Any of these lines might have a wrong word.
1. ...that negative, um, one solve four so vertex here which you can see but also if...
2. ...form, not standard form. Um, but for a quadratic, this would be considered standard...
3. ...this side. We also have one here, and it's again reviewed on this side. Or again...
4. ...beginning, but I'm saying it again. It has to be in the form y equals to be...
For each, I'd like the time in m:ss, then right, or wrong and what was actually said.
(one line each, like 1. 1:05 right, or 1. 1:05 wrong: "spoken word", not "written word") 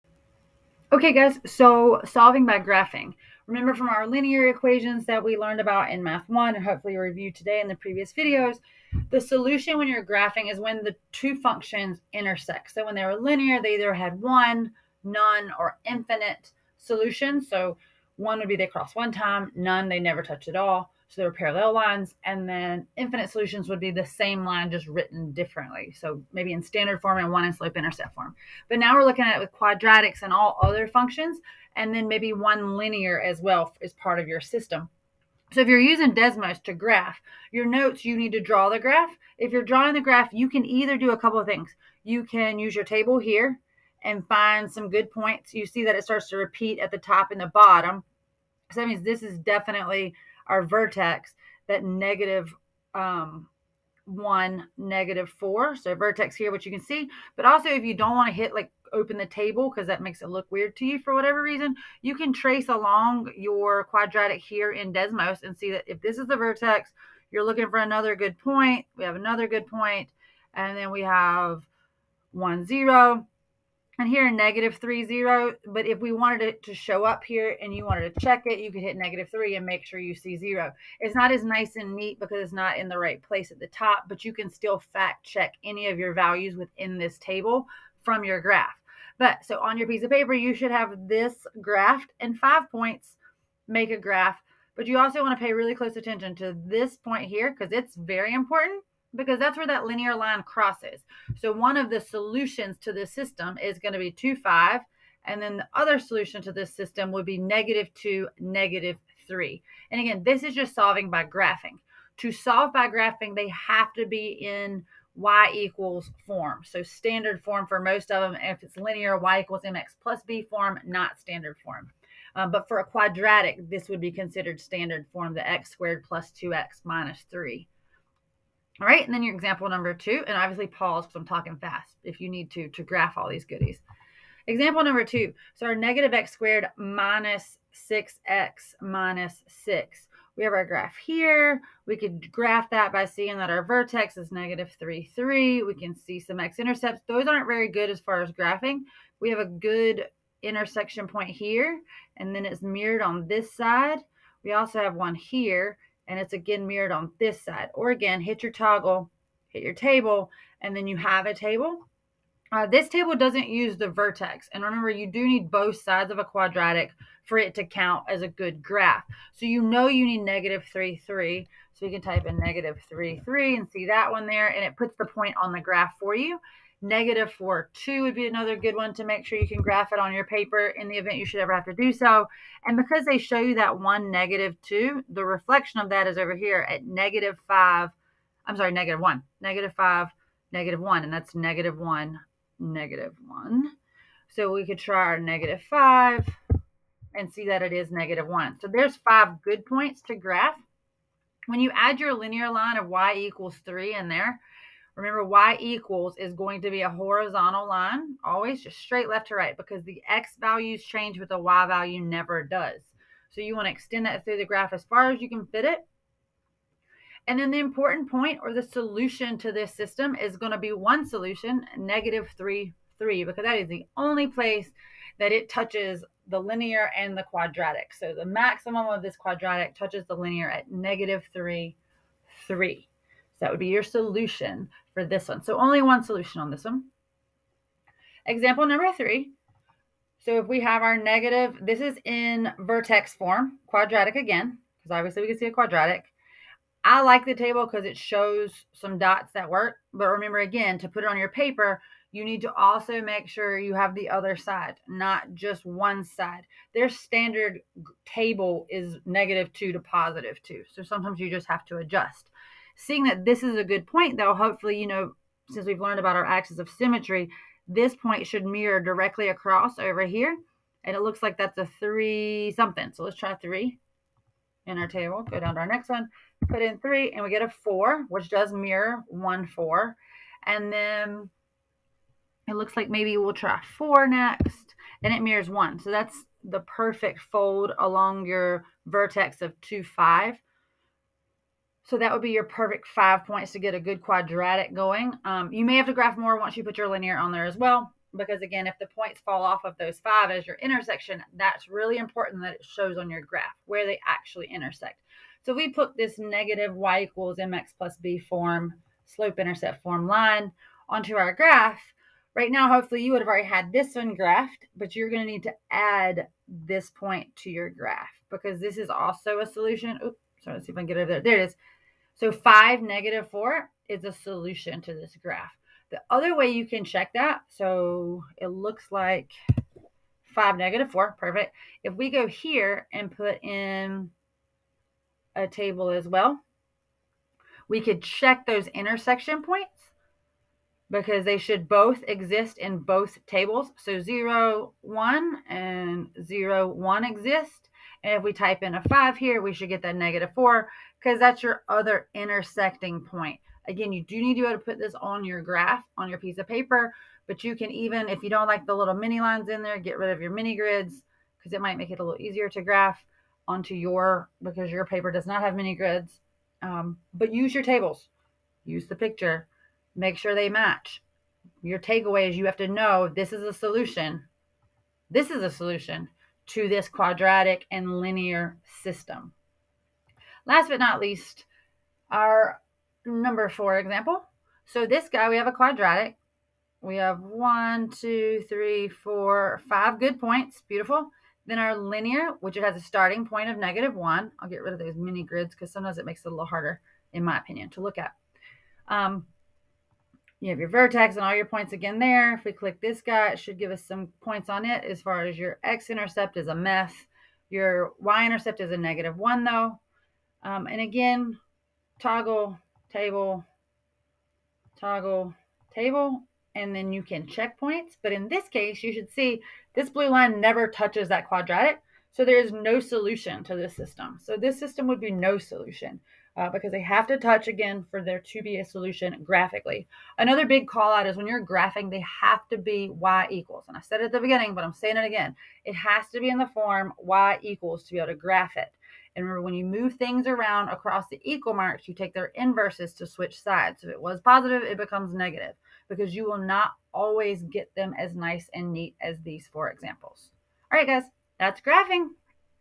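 1. 0:51 wrong: "negative", not "solve"
2. 2:00 right
3. 2:33 wrong: "mirrored", not "reviewed"
4. 7:14 right.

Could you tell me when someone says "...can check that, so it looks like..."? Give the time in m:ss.
5:26.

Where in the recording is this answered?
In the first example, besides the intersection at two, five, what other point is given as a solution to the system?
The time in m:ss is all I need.
1:47.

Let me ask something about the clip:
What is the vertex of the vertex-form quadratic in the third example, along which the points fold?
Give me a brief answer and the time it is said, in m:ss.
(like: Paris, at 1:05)
(2, 5), at 4:49.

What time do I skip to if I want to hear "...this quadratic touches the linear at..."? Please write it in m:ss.
3:49.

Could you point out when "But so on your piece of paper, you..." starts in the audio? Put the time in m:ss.
1:29.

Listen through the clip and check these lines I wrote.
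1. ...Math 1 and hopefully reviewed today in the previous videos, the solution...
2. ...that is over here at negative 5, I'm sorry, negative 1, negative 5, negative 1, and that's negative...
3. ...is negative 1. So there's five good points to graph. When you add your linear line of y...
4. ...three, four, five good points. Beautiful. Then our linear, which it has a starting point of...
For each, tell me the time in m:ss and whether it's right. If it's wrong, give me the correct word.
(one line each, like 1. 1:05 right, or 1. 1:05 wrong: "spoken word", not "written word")
1. 0:06 right
2. 3:05 right
3. 3:17 right
4. 6:28 right.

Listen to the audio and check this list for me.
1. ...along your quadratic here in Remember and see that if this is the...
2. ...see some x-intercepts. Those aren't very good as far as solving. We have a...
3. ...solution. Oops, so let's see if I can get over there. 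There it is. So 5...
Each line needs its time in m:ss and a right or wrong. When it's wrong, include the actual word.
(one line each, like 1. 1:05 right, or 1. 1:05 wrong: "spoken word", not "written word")
1. 1:02 wrong: "Desmos", not "Remember"
2. 2:25 wrong: "graphing", not "solving"
3. 5:19 right.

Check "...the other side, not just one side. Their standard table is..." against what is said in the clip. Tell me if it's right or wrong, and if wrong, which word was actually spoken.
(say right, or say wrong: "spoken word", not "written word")
right.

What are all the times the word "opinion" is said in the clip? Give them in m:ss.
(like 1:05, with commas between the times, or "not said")
6:37.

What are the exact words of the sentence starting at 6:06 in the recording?
Um, but use your tables, use the picture, make sure they match.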